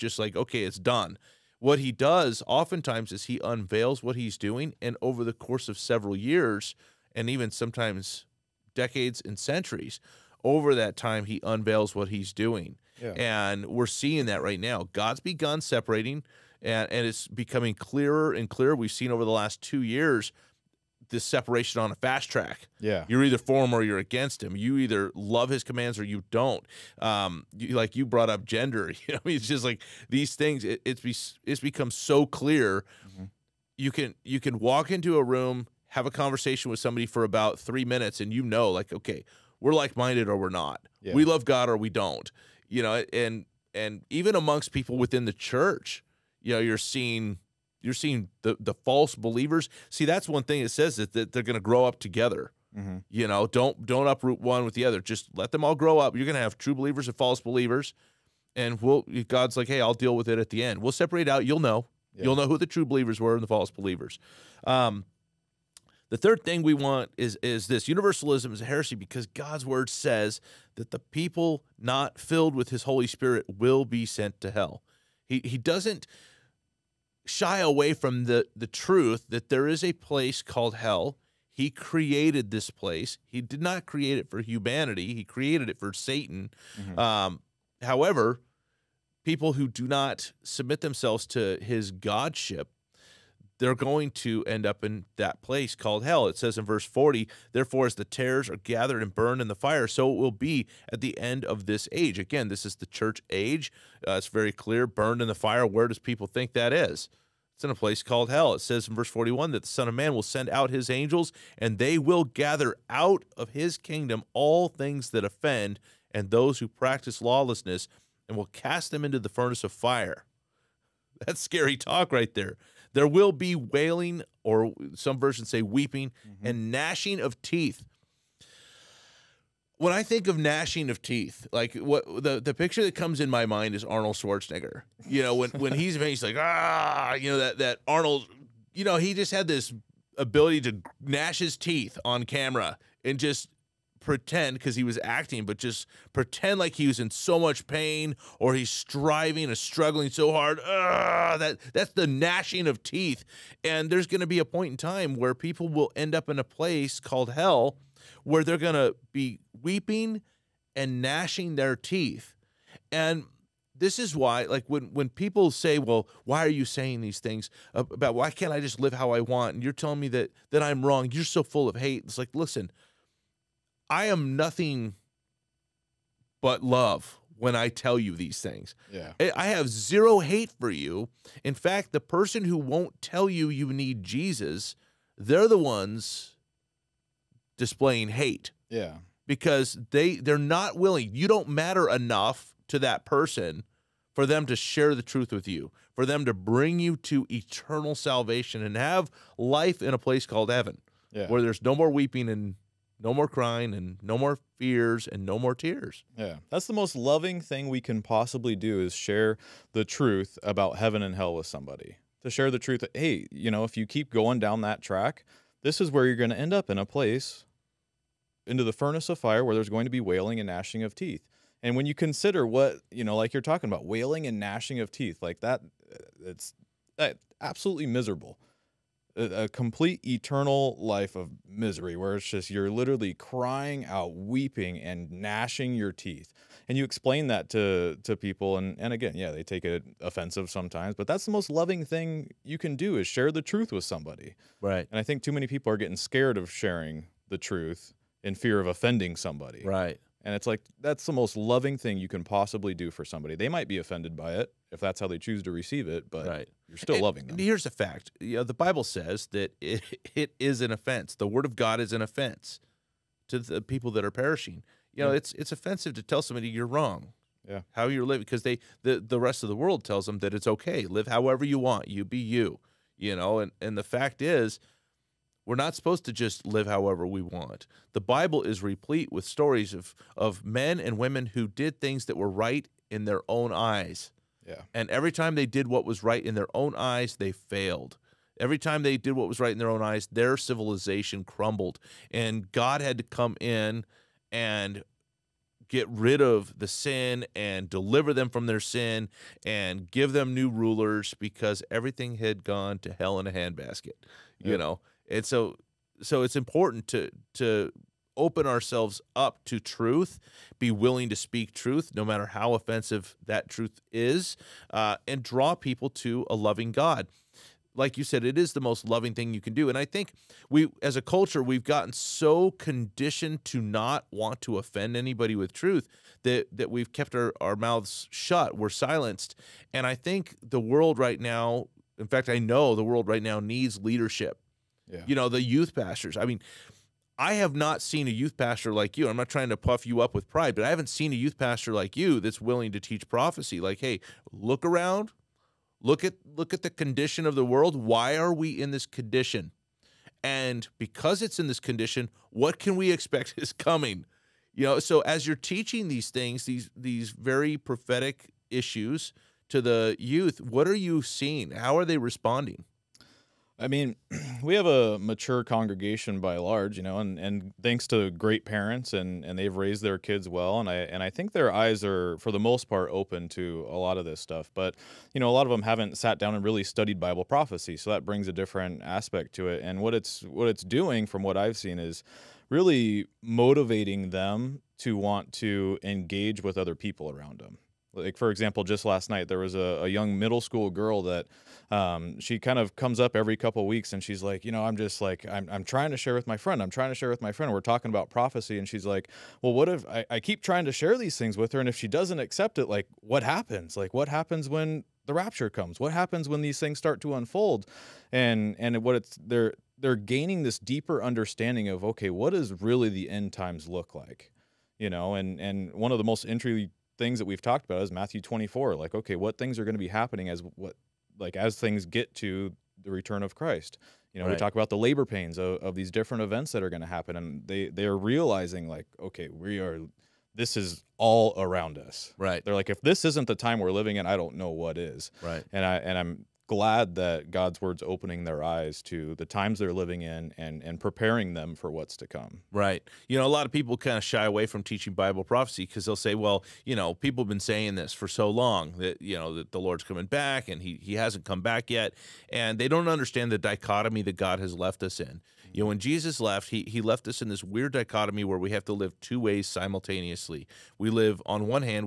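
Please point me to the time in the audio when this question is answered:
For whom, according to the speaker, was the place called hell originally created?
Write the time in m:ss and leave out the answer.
1:25.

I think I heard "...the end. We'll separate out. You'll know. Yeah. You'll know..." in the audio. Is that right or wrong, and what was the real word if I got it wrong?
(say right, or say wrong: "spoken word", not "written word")
right.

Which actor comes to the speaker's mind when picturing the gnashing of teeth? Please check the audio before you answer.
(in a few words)
Arnold Schwarzenegger.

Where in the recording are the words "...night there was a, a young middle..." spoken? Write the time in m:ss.
6:29.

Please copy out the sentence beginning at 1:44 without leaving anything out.
Uh, it's very clear burned in the fire.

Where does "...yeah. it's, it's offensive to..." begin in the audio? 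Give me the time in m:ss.
4:25.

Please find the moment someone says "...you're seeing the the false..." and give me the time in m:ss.
0:47.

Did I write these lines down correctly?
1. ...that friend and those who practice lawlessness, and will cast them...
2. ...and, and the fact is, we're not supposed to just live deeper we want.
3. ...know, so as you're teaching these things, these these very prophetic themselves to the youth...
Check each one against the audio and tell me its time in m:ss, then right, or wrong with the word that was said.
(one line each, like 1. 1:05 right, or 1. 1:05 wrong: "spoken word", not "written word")
1. 1:55 wrong: "offend", not "friend"
2. 4:33 wrong: "however", not "deeper"
3. 5:54 wrong: "issues", not "themselves".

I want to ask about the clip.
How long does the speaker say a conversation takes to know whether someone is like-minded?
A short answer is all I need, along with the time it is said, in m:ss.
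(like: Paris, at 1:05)
3 minutes, at 0:37.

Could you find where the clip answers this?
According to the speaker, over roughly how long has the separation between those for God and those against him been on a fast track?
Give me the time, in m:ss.
0:19.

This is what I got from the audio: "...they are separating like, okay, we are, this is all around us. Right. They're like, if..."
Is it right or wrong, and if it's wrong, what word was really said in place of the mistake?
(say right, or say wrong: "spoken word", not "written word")
wrong: "realizing", not "separating".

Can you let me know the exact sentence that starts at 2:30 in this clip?
Ugh, that that's the gnashing of teeth.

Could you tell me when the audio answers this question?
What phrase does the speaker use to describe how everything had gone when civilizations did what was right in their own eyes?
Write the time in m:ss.
5:02.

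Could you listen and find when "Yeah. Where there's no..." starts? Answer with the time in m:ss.
3:21.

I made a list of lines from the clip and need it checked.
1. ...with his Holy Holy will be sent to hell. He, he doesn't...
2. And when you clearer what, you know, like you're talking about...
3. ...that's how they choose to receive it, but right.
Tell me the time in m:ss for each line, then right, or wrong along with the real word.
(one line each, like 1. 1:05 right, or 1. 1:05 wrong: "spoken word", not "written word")
1. 1:12 wrong: "Spirit", not "Holy"
2. 3:41 wrong: "consider", not "clearer"
3. 4:14 right.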